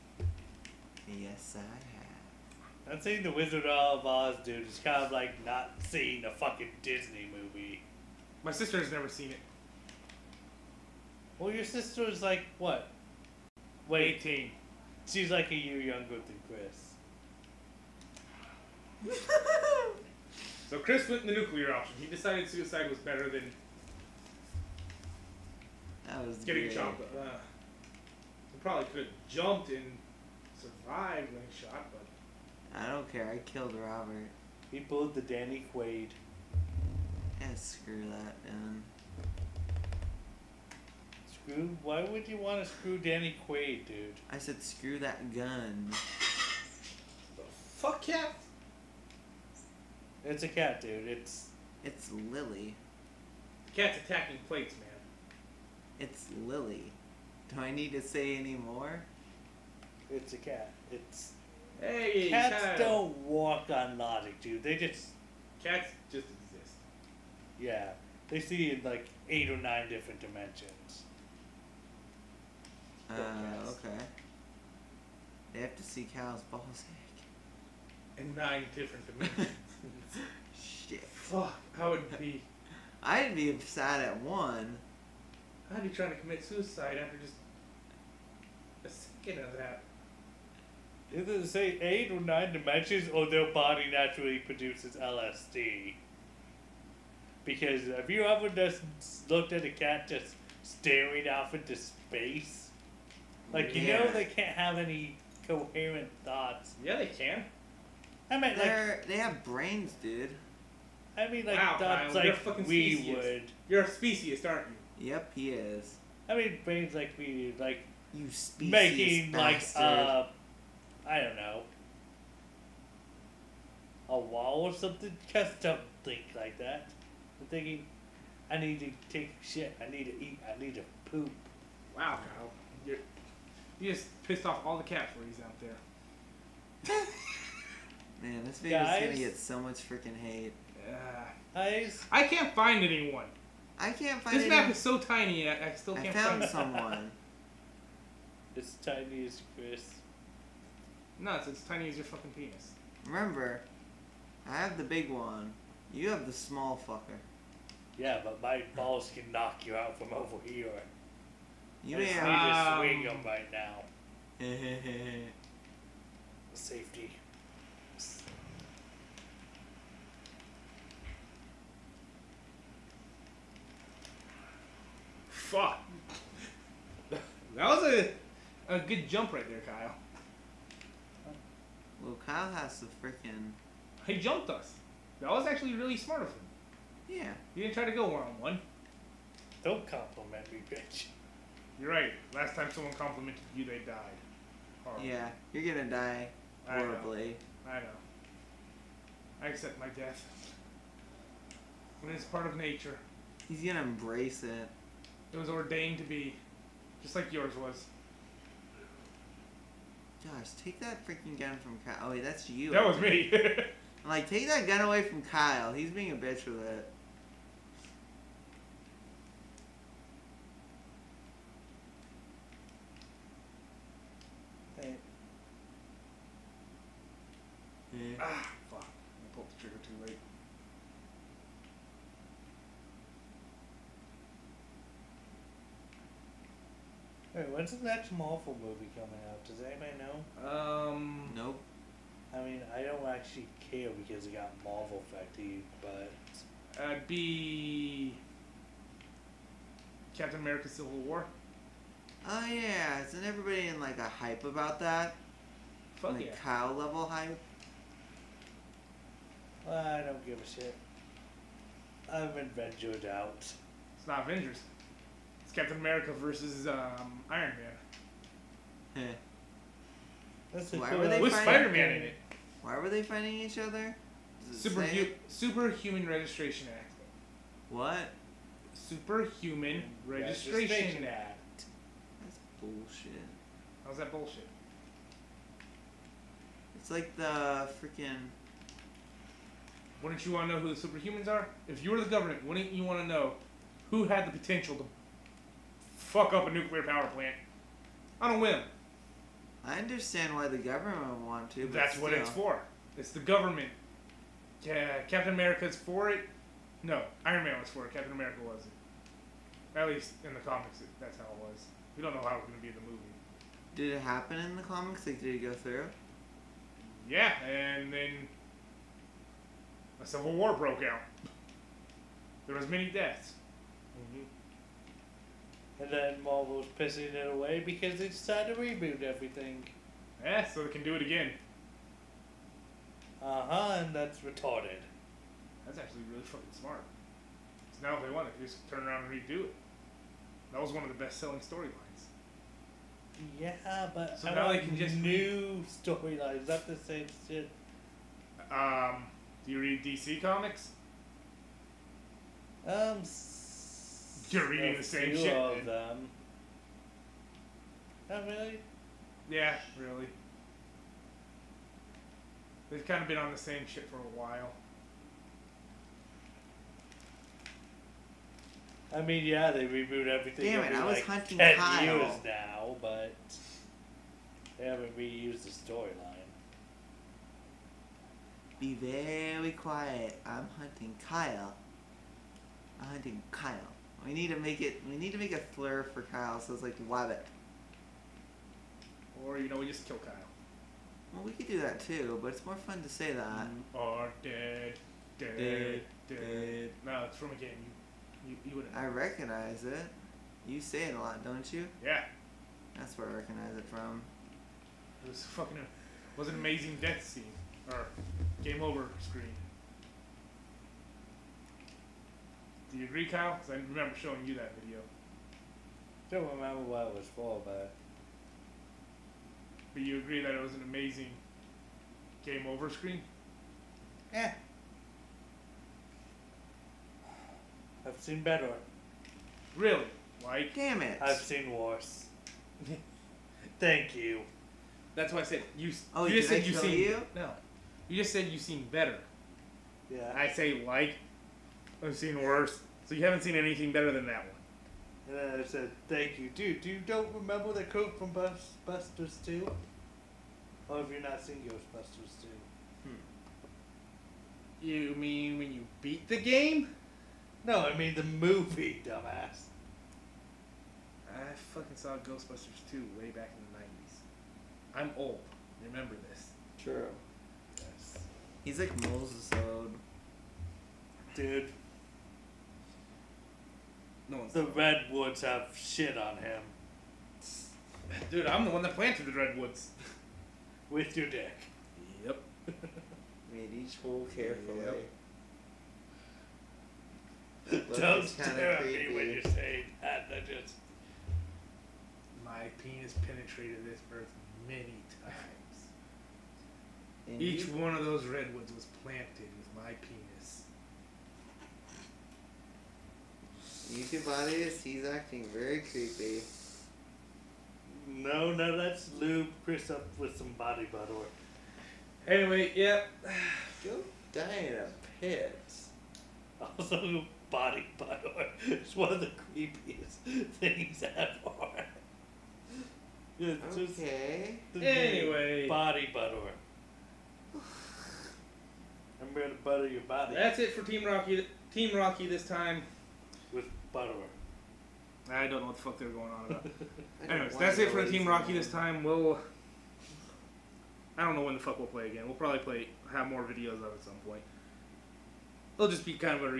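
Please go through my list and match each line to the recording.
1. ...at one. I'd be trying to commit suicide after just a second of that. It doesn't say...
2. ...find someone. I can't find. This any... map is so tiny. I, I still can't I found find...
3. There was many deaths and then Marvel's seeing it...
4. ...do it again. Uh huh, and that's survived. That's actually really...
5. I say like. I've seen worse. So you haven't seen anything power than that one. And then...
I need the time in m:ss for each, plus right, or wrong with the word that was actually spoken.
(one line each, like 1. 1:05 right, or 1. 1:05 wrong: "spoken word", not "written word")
1. 1:24 right
2. 2:22 wrong: "anyone", not "someone"
3. 5:22 wrong: "pissing", not "seeing"
4. 5:30 wrong: "retarded", not "survived"
5. 7:20 wrong: "better", not "power".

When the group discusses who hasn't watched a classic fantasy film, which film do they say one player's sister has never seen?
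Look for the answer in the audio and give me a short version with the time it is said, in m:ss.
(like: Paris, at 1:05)
The Wizard of Oz, at 0:03.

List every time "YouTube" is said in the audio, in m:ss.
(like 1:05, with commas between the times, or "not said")
8:23.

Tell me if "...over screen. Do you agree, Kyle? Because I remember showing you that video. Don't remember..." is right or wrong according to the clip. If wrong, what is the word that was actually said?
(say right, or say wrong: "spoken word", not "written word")
right.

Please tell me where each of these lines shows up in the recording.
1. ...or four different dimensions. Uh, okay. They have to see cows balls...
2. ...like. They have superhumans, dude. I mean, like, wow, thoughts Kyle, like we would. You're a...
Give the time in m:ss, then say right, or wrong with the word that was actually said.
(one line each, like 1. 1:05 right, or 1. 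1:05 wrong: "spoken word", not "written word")
1. 1:09 wrong: "nine", not "four"
2. 1:48 wrong: "brains", not "superhumans".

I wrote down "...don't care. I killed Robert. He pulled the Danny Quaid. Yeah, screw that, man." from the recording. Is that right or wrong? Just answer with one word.
right.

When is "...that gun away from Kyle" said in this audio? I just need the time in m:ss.
3:34.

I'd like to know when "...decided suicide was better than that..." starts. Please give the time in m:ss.
0:22.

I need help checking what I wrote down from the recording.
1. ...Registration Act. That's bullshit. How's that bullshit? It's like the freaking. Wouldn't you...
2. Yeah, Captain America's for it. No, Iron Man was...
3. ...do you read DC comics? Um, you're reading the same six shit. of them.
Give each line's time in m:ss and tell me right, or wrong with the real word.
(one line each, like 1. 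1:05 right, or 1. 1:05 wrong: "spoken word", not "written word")
1. 4:40 right
2. 5:04 right
3. 5:49 wrong: "two", not "six".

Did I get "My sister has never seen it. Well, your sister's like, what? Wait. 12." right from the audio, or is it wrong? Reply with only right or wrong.
wrong.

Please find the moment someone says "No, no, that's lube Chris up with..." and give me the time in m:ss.
8:27.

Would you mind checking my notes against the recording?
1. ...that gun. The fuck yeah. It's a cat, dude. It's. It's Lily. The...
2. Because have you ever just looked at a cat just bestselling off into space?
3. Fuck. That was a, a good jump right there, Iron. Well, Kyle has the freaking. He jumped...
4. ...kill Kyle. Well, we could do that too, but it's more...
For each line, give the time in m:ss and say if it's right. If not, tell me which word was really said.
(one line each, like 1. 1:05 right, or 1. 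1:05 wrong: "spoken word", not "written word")
1. 0:44 right
2. 1:37 wrong: "staring", not "bestselling"
3. 2:55 wrong: "Kyle", not "Iron"
4. 6:29 right.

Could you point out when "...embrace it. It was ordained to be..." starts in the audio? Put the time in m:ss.
3:23.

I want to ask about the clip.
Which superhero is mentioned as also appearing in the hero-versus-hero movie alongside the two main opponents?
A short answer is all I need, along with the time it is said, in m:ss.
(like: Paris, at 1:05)
Spider Man, at 4:31.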